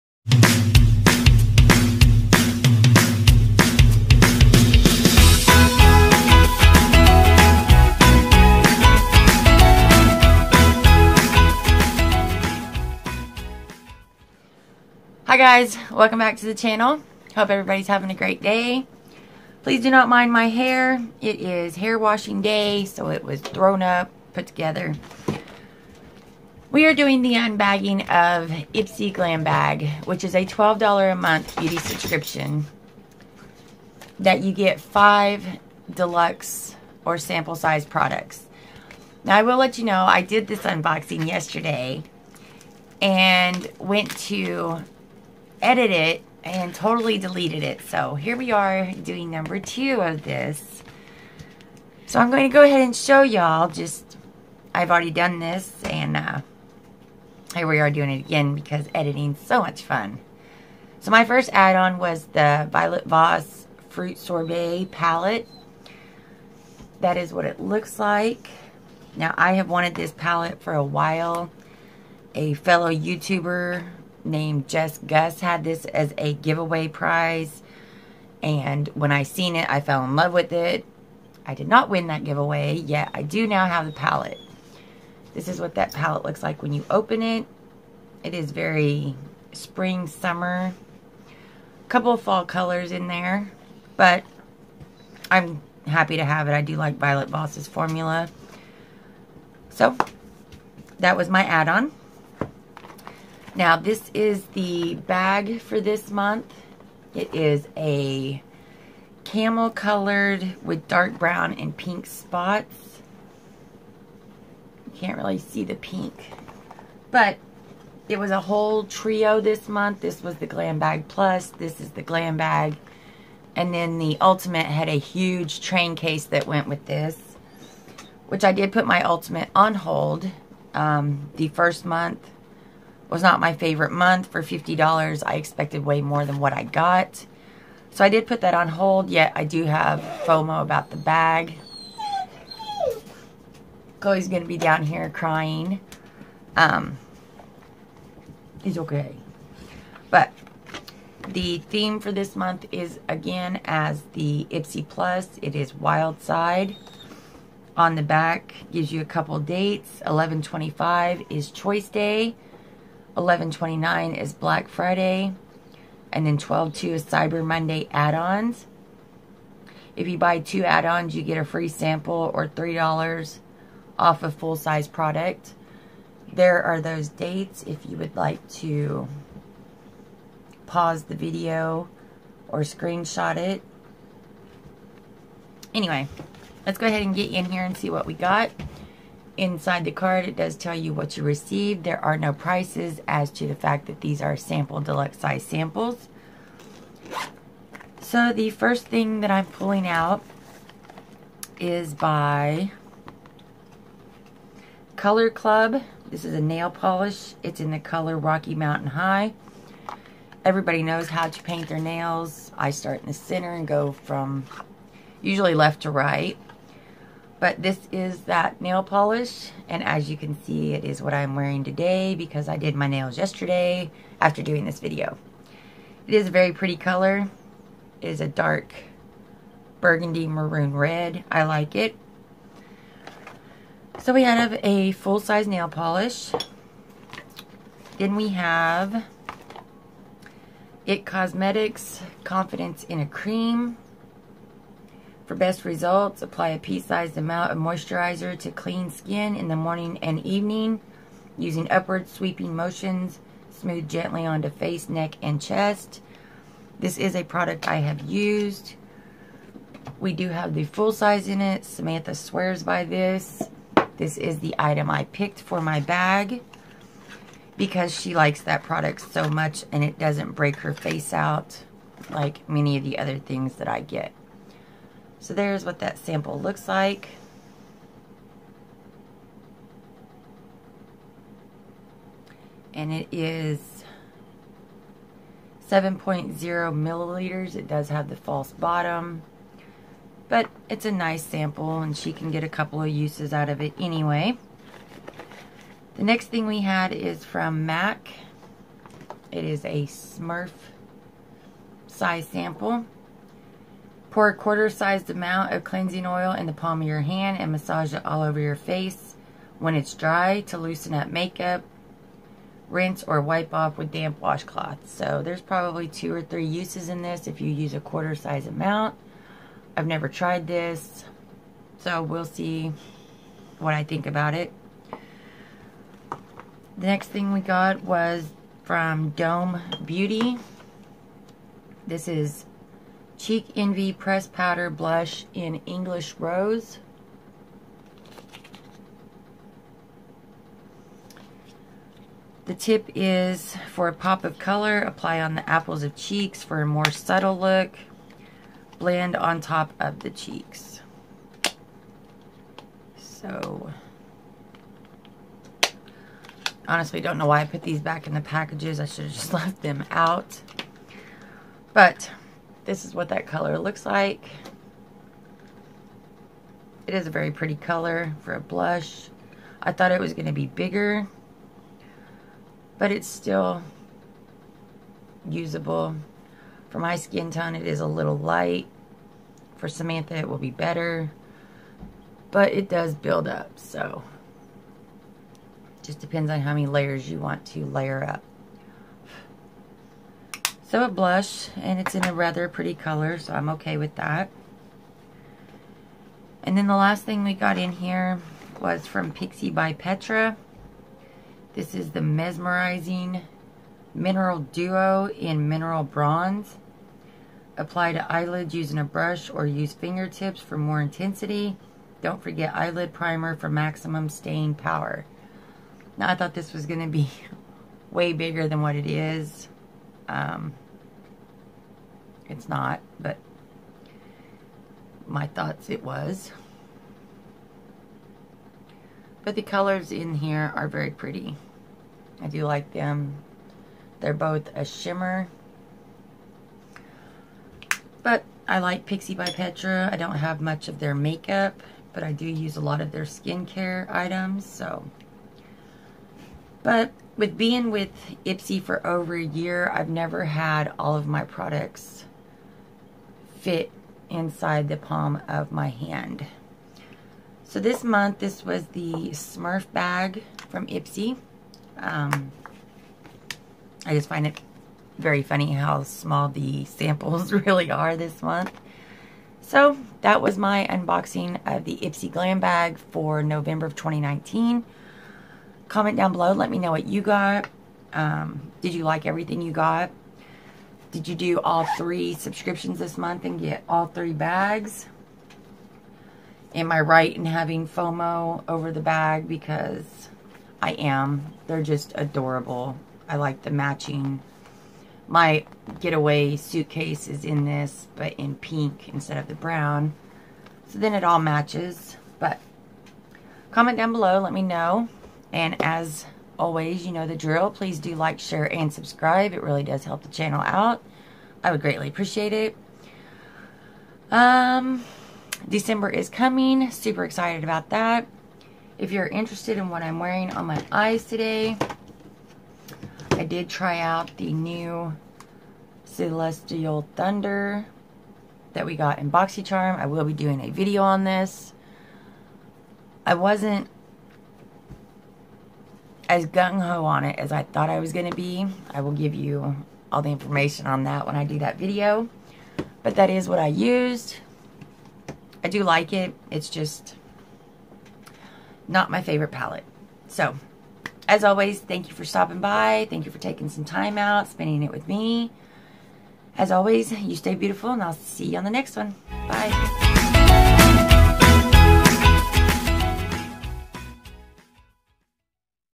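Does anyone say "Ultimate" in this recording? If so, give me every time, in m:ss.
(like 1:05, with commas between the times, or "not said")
2:04, 2:09.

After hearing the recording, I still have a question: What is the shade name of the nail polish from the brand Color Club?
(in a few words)
Rocky Mountain High.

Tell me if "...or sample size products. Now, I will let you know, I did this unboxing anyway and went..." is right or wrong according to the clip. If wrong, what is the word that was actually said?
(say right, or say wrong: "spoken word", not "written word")
wrong: "yesterday", not "anyway".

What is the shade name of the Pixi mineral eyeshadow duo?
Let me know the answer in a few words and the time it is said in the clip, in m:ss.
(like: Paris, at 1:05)
Mineral Bronze, at 6:45.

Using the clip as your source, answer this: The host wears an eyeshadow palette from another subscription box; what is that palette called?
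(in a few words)
Celestial Thunder.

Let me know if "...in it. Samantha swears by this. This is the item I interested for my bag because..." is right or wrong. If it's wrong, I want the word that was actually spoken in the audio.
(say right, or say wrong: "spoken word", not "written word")
wrong: "picked", not "interested".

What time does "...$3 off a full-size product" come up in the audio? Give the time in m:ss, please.
2:52.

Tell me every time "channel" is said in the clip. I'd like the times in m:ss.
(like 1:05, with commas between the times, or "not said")
0:16, 8:30.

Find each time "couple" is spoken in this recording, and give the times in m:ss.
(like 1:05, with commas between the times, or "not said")
1:31, 2:39, 4:52.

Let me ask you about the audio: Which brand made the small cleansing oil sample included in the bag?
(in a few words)
MAC.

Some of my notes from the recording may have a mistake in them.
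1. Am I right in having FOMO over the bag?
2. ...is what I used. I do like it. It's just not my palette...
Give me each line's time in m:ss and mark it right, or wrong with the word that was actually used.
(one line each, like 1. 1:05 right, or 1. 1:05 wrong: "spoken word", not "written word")
1. 8:06 right
2. 9:03 wrong: "favorite", not "palette".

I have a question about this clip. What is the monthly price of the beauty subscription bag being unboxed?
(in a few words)
$12.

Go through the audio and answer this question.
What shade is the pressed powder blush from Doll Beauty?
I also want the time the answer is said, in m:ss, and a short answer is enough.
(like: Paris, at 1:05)
English Rose, at 5:35.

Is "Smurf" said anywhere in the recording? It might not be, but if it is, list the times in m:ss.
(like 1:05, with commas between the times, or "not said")
4:59, 7:39.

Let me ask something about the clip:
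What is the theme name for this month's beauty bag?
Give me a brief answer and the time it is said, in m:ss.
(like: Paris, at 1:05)
Wild Side, at 2:35.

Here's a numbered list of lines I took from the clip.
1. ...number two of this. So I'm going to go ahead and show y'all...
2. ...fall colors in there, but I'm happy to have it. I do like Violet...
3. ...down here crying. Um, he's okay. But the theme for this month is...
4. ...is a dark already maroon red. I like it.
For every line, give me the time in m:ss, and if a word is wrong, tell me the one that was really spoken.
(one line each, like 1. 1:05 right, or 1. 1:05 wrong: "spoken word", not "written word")
1. 0:49 right
2. 1:32 right
3. 2:24 right
4. 3:48 wrong: "burgundy", not "already".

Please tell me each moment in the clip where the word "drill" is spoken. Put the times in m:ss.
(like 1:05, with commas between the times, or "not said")
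8:27.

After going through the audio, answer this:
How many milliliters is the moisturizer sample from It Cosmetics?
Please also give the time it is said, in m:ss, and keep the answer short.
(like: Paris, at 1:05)
7.0, at 4:45.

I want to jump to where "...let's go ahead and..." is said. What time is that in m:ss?
3:06.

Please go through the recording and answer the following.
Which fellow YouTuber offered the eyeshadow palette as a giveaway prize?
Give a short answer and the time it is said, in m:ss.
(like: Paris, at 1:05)
Jess Gus, at 1:14.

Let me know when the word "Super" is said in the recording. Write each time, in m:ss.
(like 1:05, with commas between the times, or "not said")
8:36.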